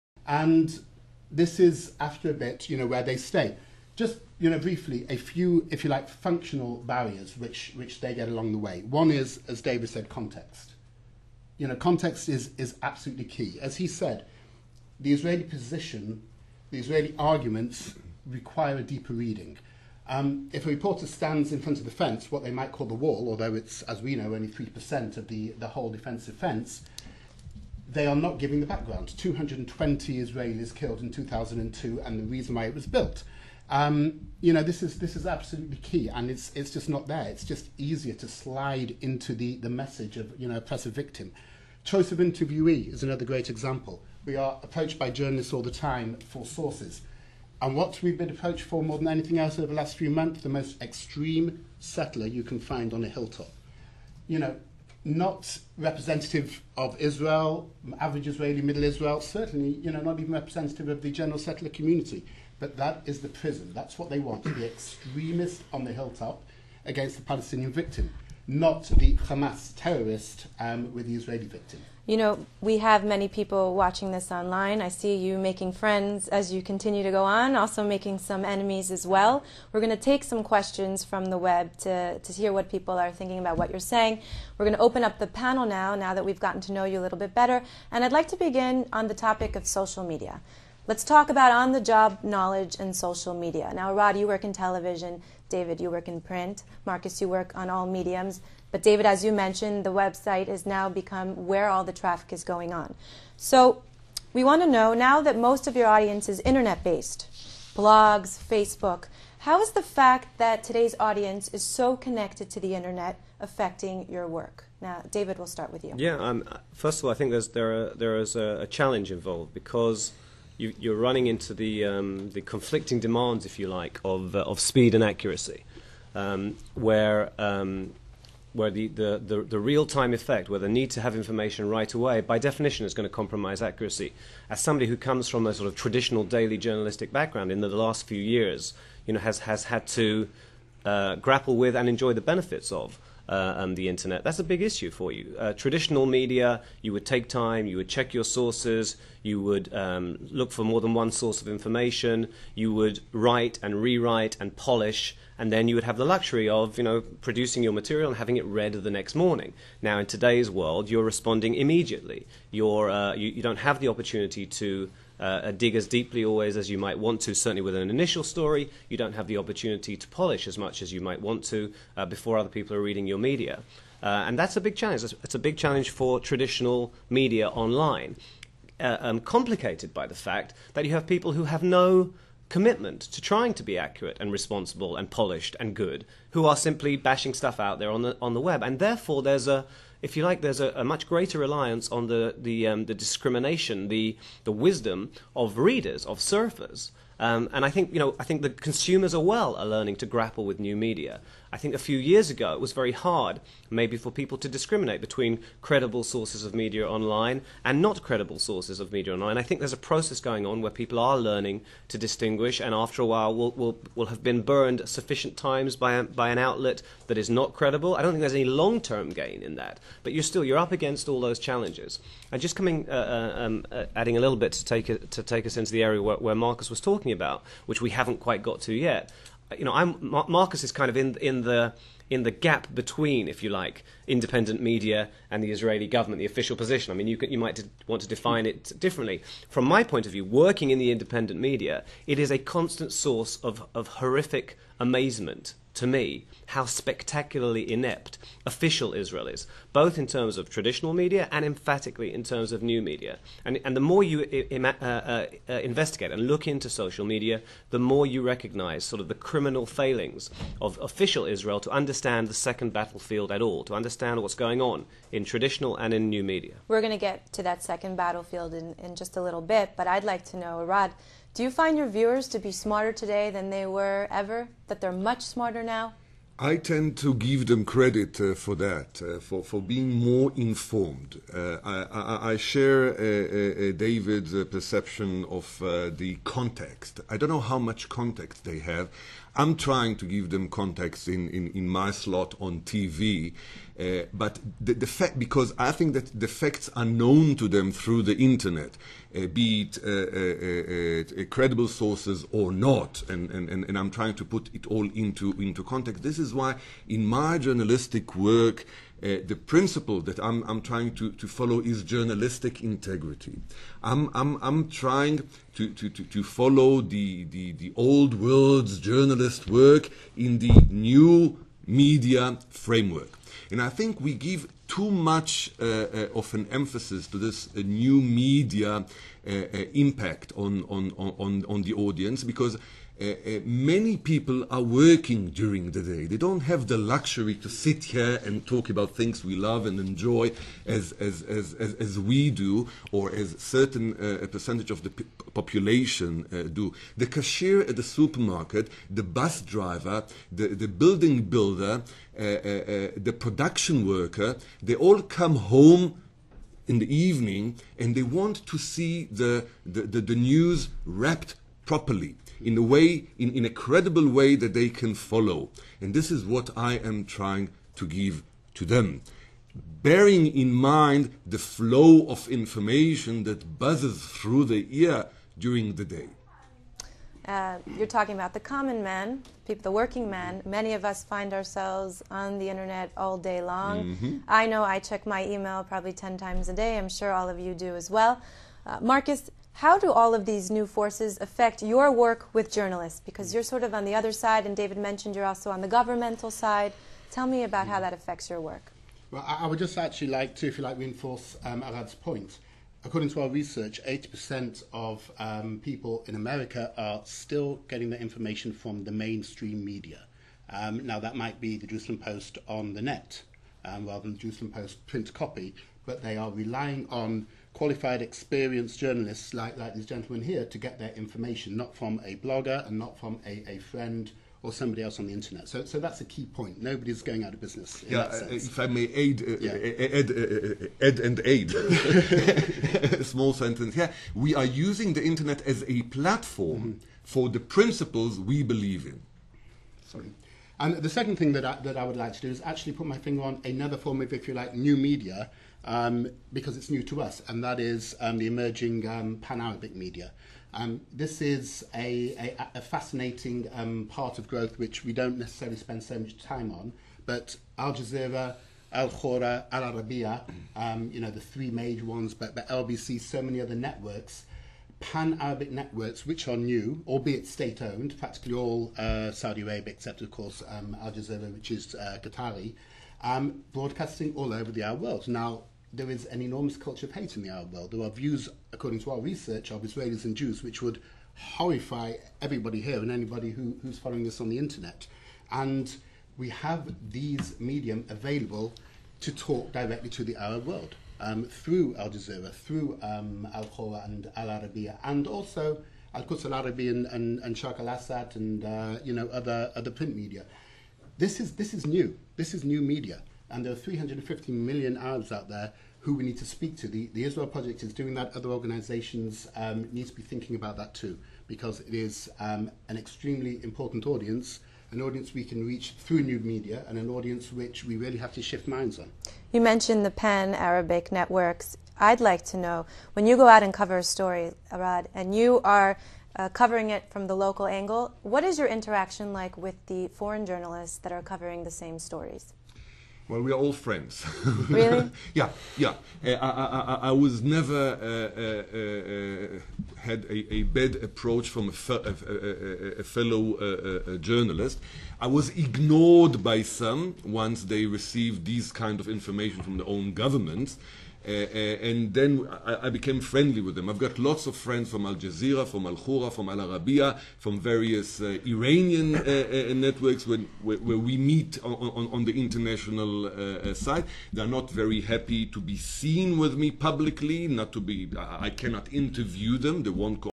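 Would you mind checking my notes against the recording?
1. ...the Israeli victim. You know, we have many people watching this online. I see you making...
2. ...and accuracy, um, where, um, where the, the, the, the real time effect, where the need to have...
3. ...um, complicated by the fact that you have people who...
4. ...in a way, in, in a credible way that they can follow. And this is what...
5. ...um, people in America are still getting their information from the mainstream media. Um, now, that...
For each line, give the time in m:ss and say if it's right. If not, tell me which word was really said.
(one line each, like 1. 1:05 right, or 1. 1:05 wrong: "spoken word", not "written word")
1. 1:11 right
2. 2:04 right
3. 2:58 right
4. 6:02 right
5. 6:45 right.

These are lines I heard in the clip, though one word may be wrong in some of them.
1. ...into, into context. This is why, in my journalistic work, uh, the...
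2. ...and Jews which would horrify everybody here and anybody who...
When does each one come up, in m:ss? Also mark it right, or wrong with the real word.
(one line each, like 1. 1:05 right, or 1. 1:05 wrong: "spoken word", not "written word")
1. 5:04 right
2. 8:00 right.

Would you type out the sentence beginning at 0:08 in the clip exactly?
One is, as David said, context.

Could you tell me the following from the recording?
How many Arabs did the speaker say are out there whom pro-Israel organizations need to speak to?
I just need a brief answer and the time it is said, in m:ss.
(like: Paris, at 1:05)
350 million, at 8:23.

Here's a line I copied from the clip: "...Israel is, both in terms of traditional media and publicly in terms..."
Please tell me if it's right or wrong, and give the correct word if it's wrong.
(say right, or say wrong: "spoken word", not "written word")
wrong: "emphatically", not "publicly".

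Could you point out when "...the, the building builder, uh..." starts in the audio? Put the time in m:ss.
5:50.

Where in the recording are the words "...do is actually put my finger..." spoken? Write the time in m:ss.
7:22.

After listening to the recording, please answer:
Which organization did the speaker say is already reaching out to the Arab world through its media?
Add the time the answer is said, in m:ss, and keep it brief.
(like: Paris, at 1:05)
The Israel Project, at 8:26.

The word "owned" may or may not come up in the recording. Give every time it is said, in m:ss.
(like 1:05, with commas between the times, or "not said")
7:47.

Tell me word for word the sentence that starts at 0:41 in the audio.
Choice of interviewee is another great example.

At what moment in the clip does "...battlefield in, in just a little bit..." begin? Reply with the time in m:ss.
4:27.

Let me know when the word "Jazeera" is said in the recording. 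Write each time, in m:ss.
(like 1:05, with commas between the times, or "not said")
7:37, 7:50, 8:11, 9:14.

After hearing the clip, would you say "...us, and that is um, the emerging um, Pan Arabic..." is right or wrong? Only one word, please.
right.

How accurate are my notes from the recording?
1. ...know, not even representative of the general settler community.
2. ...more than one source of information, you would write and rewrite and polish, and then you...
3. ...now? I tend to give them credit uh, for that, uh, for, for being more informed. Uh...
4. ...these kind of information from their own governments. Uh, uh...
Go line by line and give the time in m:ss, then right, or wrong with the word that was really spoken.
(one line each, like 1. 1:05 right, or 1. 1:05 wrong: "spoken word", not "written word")
1. 0:59 right
2. 2:30 right
3. 4:35 right
4. 9:08 right.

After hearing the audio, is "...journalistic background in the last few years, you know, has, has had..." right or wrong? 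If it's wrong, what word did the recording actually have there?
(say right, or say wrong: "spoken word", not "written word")
right.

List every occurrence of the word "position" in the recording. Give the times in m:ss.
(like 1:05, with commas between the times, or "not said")
0:15, 3:56.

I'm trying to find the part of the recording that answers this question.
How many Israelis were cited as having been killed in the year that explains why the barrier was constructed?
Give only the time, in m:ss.
0:29.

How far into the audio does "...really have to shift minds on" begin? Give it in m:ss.
8:37.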